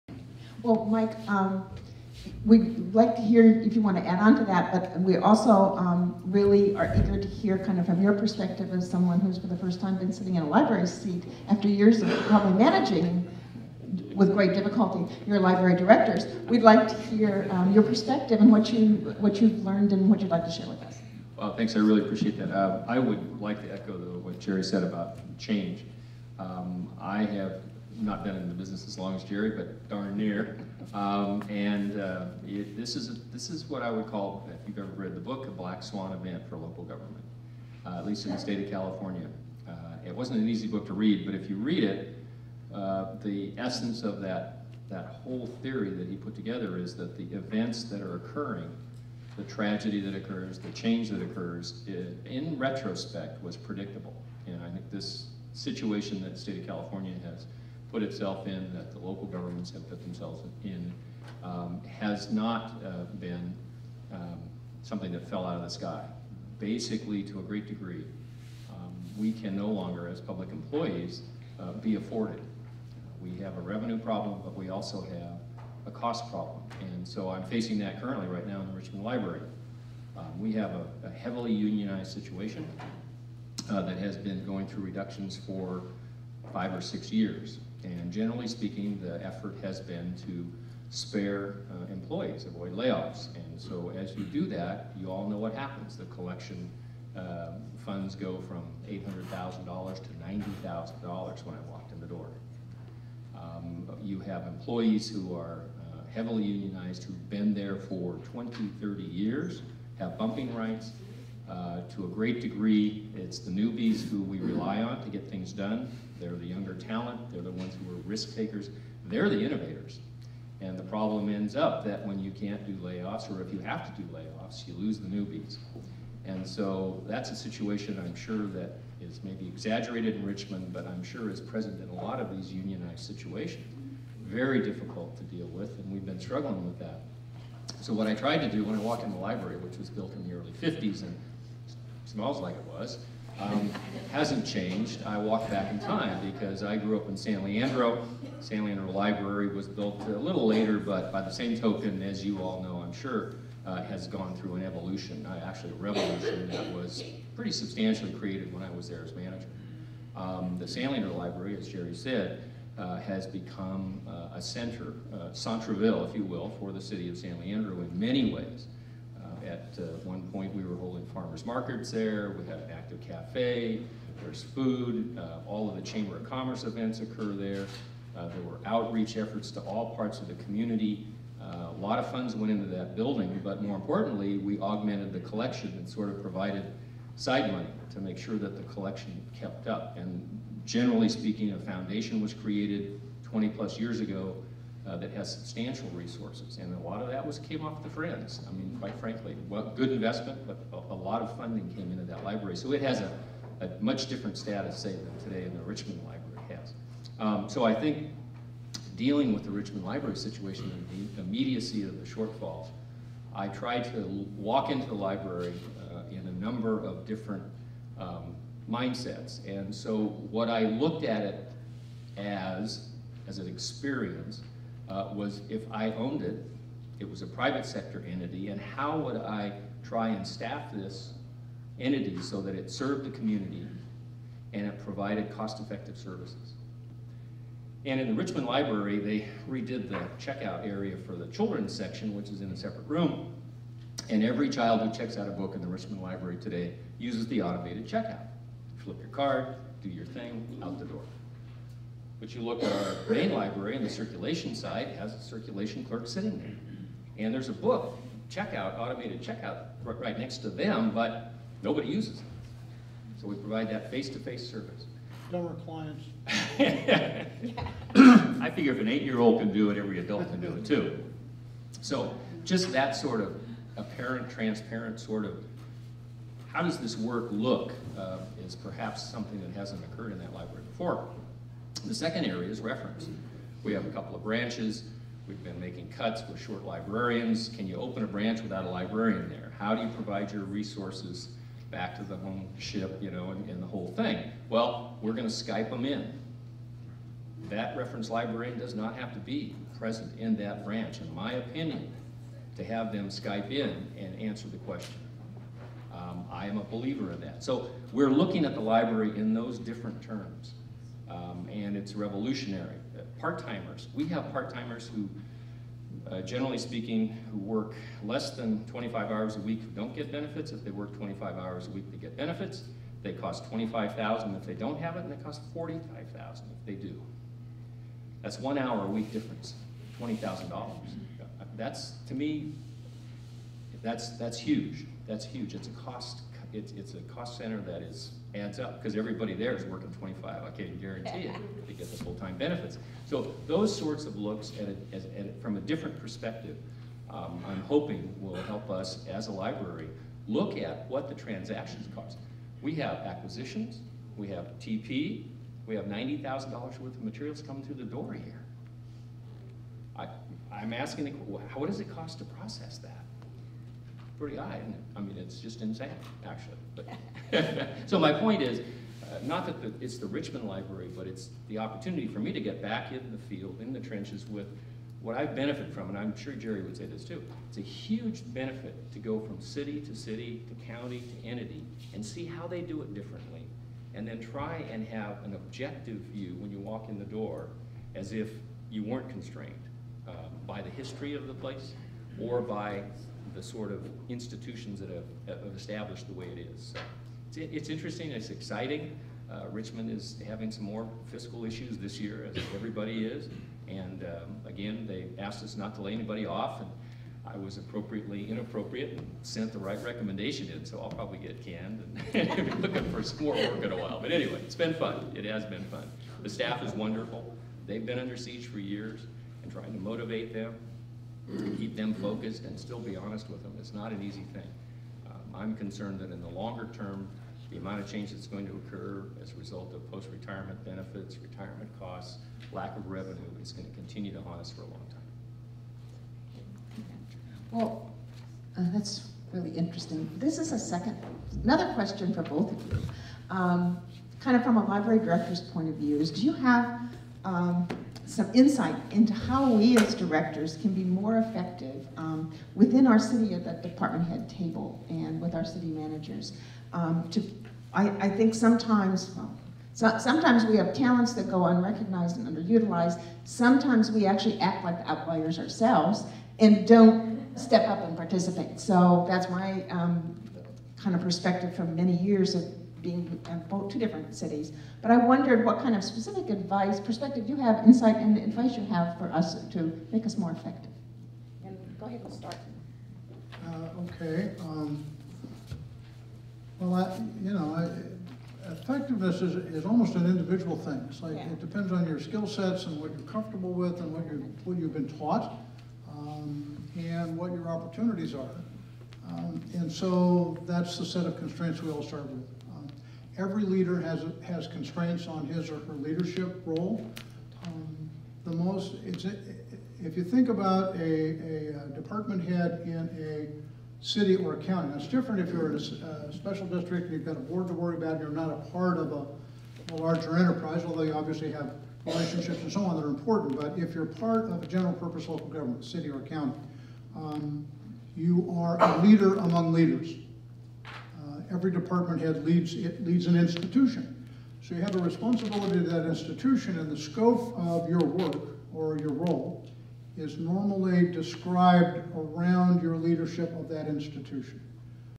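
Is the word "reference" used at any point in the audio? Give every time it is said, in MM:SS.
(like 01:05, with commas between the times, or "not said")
04:42, 04:57.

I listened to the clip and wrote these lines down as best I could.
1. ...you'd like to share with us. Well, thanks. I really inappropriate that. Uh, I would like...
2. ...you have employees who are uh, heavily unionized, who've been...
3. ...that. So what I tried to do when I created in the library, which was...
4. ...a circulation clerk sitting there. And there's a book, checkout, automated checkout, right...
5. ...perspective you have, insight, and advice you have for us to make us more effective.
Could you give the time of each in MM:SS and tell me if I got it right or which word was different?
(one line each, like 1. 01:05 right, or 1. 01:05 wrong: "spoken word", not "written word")
1. 00:20 wrong: "appreciate", not "inappropriate"
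2. 01:44 right
3. 02:16 wrong: "walked", not "created"
4. 04:15 right
5. 07:56 right.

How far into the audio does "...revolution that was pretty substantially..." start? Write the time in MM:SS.
02:35.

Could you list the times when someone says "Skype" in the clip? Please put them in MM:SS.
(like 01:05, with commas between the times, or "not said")
04:55, 05:03.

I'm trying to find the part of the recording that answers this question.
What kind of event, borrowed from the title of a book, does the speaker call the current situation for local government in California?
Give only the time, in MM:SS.
00:35.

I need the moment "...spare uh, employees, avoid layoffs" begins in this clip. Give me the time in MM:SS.
01:30.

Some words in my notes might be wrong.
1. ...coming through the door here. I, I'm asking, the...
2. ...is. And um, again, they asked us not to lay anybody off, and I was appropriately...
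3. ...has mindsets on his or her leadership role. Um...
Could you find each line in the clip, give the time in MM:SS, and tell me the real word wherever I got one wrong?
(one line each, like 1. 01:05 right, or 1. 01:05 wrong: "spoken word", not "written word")
1. 05:57 right
2. 06:43 right
3. 08:24 wrong: "constraints", not "mindsets".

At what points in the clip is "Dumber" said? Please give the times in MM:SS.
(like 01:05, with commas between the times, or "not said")
04:25.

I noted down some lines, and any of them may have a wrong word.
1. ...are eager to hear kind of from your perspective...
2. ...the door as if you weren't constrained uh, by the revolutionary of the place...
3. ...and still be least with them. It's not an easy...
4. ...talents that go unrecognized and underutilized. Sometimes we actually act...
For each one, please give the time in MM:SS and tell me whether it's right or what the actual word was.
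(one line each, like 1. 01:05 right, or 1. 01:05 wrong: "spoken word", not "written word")
1. 00:06 right
2. 06:26 wrong: "history", not "revolutionary"
3. 07:02 wrong: "honest", not "least"
4. 07:40 right.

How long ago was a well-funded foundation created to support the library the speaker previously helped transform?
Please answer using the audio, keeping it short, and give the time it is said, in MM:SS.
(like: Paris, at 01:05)
20 plus years, at 03:13.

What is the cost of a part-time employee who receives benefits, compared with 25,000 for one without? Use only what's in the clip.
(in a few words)
45,000.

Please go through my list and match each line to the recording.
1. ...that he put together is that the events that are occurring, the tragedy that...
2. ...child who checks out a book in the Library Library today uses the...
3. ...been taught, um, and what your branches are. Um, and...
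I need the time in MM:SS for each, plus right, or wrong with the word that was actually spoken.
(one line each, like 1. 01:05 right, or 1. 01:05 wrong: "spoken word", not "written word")
1. 00:45 right
2. 04:04 wrong: "Richmond", not "Library"
3. 08:14 wrong: "opportunities", not "branches".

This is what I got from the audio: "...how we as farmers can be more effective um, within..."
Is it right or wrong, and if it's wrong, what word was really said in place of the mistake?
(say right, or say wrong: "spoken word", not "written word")
wrong: "directors", not "farmers".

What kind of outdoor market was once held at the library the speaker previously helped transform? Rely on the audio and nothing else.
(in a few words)
farmers markets.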